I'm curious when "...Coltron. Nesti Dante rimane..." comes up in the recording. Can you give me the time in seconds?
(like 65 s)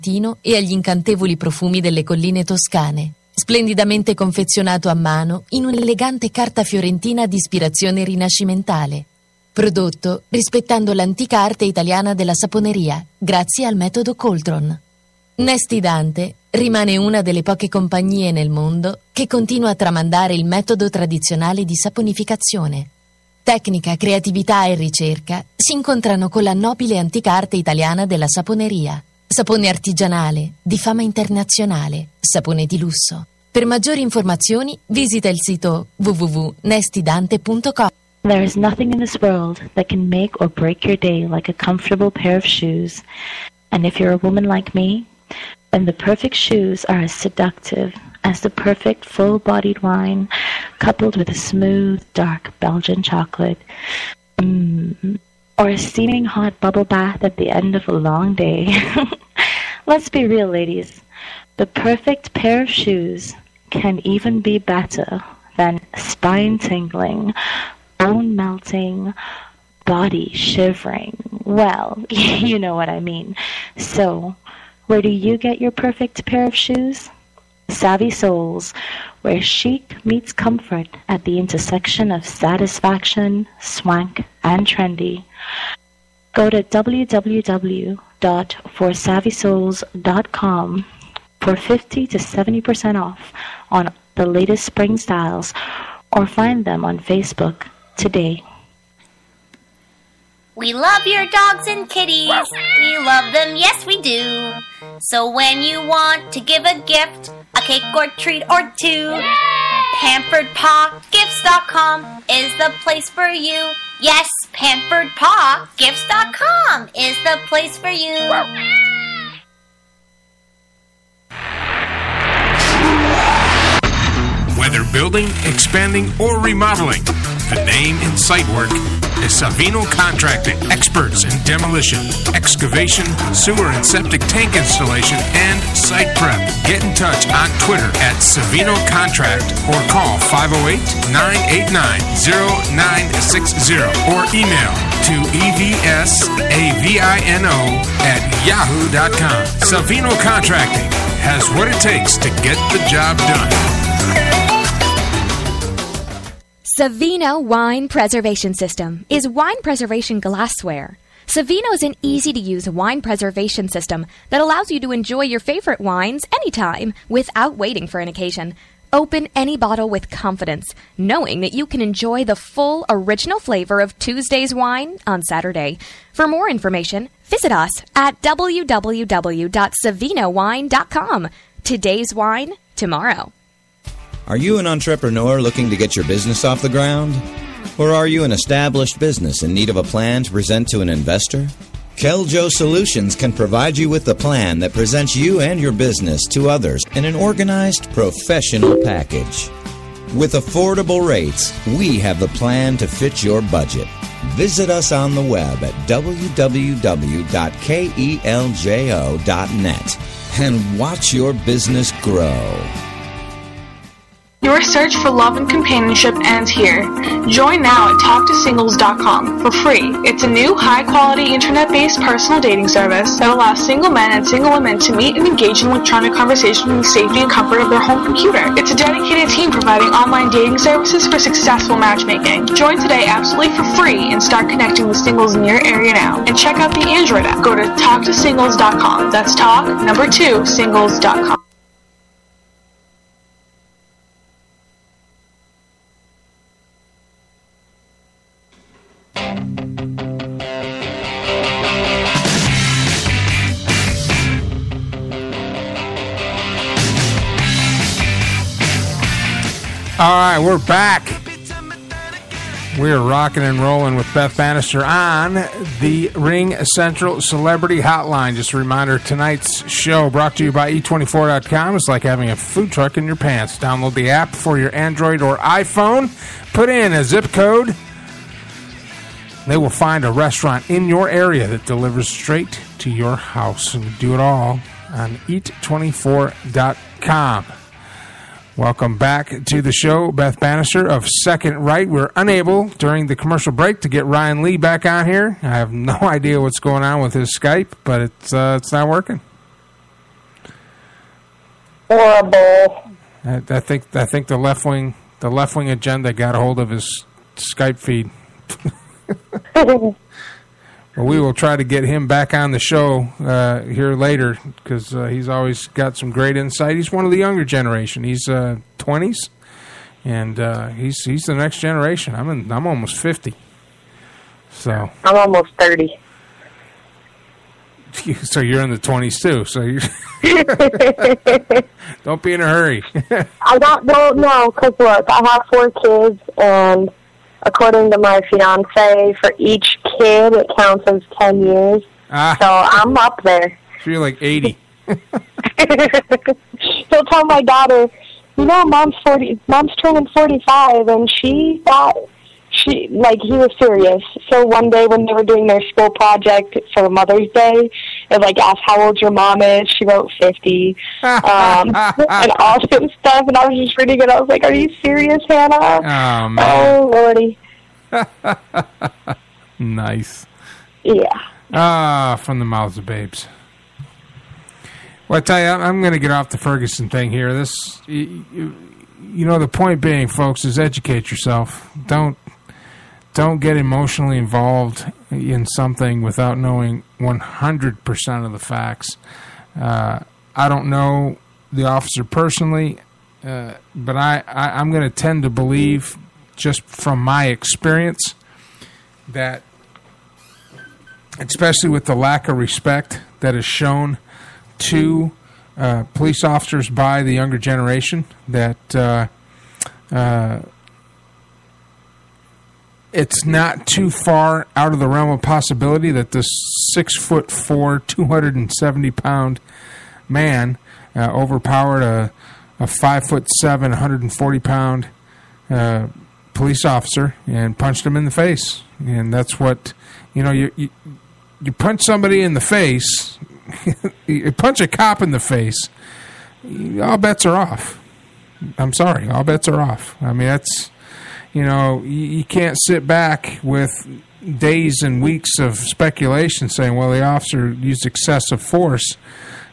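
14 s.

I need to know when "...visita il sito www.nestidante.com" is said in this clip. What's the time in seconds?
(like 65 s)
34 s.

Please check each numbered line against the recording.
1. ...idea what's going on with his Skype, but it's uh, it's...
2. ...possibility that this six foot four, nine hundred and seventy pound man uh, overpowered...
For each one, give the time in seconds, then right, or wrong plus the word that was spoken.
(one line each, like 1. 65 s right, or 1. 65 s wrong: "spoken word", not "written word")
1. 296 s right
2. 415 s wrong: "two", not "nine".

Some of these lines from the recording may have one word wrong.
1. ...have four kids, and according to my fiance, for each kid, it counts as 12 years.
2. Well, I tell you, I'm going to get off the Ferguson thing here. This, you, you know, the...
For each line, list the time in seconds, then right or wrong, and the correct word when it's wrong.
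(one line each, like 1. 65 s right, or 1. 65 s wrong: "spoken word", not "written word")
1. 335 s wrong: "10", not "12"
2. 375 s right.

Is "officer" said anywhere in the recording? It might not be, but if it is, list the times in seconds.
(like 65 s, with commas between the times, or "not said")
391 s, 406 s, 426 s, 447 s.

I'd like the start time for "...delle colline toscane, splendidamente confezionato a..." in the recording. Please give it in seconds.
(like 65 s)
1 s.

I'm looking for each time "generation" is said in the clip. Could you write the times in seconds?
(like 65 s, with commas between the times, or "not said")
317 s, 321 s, 407 s.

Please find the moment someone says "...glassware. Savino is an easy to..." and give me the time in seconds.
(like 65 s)
160 s.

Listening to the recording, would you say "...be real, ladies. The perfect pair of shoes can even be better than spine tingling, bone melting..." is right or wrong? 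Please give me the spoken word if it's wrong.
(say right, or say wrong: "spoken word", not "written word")
right.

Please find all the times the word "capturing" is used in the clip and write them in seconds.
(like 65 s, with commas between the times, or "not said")
not said.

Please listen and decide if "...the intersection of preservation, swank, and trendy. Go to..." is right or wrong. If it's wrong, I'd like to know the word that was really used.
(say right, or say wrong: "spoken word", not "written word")
wrong: "satisfaction", not "preservation".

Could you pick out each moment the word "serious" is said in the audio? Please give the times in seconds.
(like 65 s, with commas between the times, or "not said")
353 s, 364 s.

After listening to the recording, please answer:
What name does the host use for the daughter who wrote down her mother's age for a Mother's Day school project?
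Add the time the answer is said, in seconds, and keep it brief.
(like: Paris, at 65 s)
Hannah, at 365 s.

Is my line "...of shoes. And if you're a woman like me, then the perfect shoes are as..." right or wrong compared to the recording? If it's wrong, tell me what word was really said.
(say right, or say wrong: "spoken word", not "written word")
right.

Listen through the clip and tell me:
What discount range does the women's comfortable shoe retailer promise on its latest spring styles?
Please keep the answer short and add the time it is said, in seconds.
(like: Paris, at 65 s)
50 to 70%, at 91 s.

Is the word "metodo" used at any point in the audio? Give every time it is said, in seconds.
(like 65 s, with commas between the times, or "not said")
13 s, 20 s.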